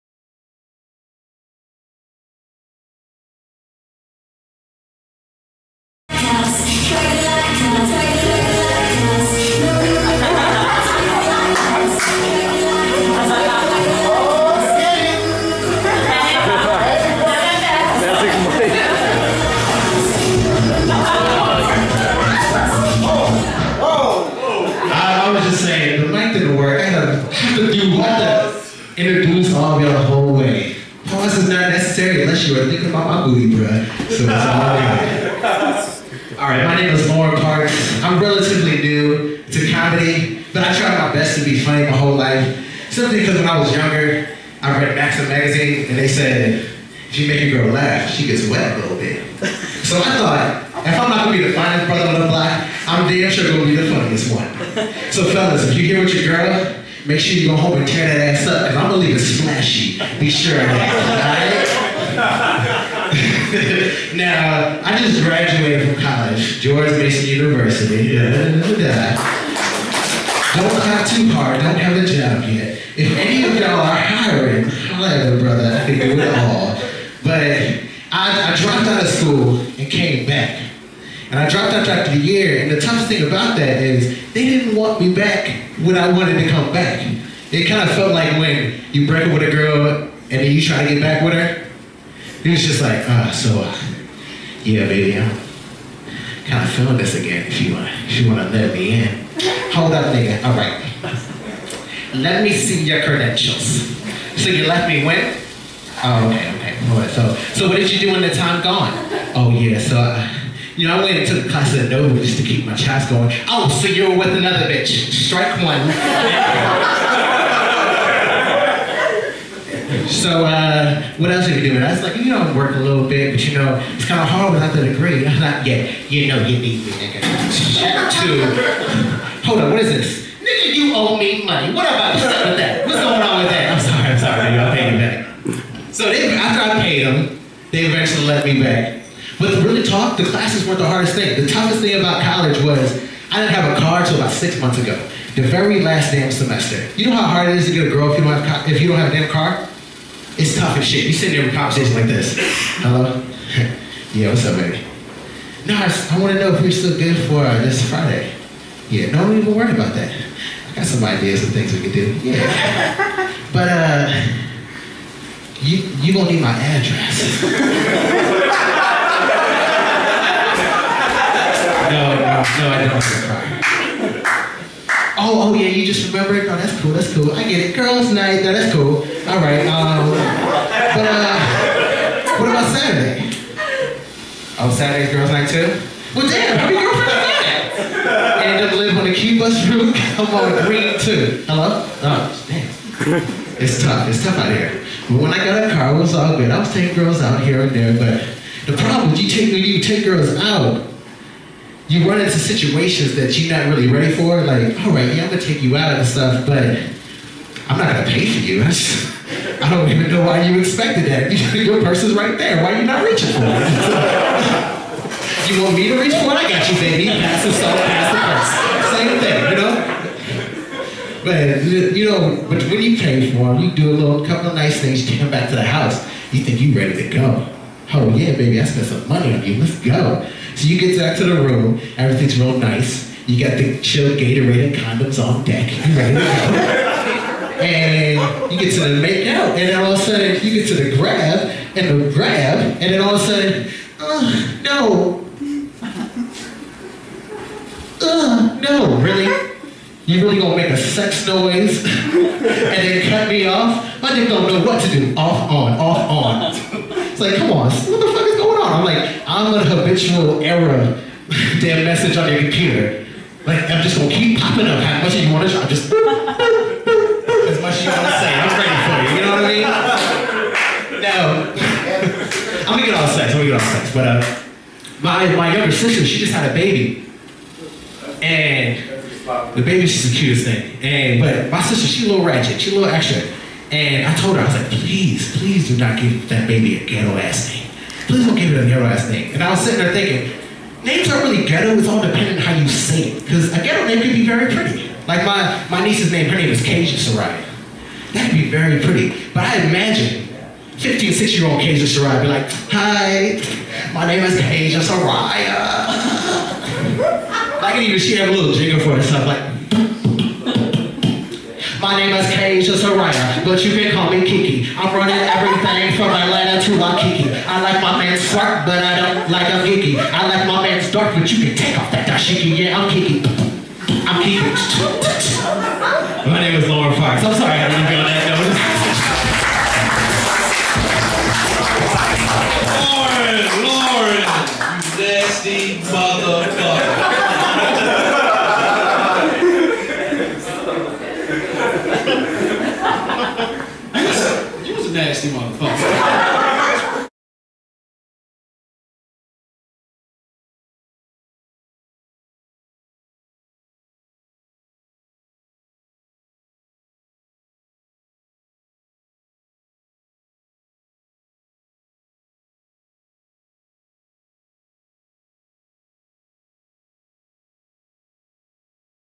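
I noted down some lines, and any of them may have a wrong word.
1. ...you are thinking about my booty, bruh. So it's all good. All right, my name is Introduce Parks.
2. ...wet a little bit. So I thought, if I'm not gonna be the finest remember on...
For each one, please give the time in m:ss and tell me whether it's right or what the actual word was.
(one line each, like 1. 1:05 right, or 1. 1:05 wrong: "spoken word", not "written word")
1. 0:32 wrong: "Loren", not "Introduce"
2. 0:48 wrong: "brother", not "remember".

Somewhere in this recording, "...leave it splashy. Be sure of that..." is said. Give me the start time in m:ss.
0:58.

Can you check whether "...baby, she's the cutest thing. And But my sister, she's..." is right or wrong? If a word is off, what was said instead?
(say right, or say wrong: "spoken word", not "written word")
right.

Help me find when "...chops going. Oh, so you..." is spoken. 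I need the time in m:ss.
1:52.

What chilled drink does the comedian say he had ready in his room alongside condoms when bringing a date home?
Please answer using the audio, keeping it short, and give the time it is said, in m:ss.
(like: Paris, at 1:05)
Gatorade, at 3:54.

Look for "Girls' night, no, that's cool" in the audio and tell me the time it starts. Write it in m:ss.
2:57.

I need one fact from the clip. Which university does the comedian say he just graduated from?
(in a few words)
George Mason University.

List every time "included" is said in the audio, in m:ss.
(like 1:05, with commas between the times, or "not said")
not said.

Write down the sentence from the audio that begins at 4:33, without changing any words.
But uh, my, my younger sister, she just had a baby.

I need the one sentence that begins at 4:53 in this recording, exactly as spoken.
Because a ghetto name could be very pretty.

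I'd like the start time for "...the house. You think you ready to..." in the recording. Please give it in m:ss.
3:45.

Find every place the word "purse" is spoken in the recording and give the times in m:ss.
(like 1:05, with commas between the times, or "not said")
3:31, 3:38.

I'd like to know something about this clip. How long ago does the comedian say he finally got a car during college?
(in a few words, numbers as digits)
About 6 months ago.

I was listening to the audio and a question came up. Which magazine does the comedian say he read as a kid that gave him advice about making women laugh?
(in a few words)
Maxim.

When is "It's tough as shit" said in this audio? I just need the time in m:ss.
2:30.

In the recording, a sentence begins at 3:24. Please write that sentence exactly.
Like, all right, yeah, I'm gonna take you out and stuff, but I'm not gonna pay for you.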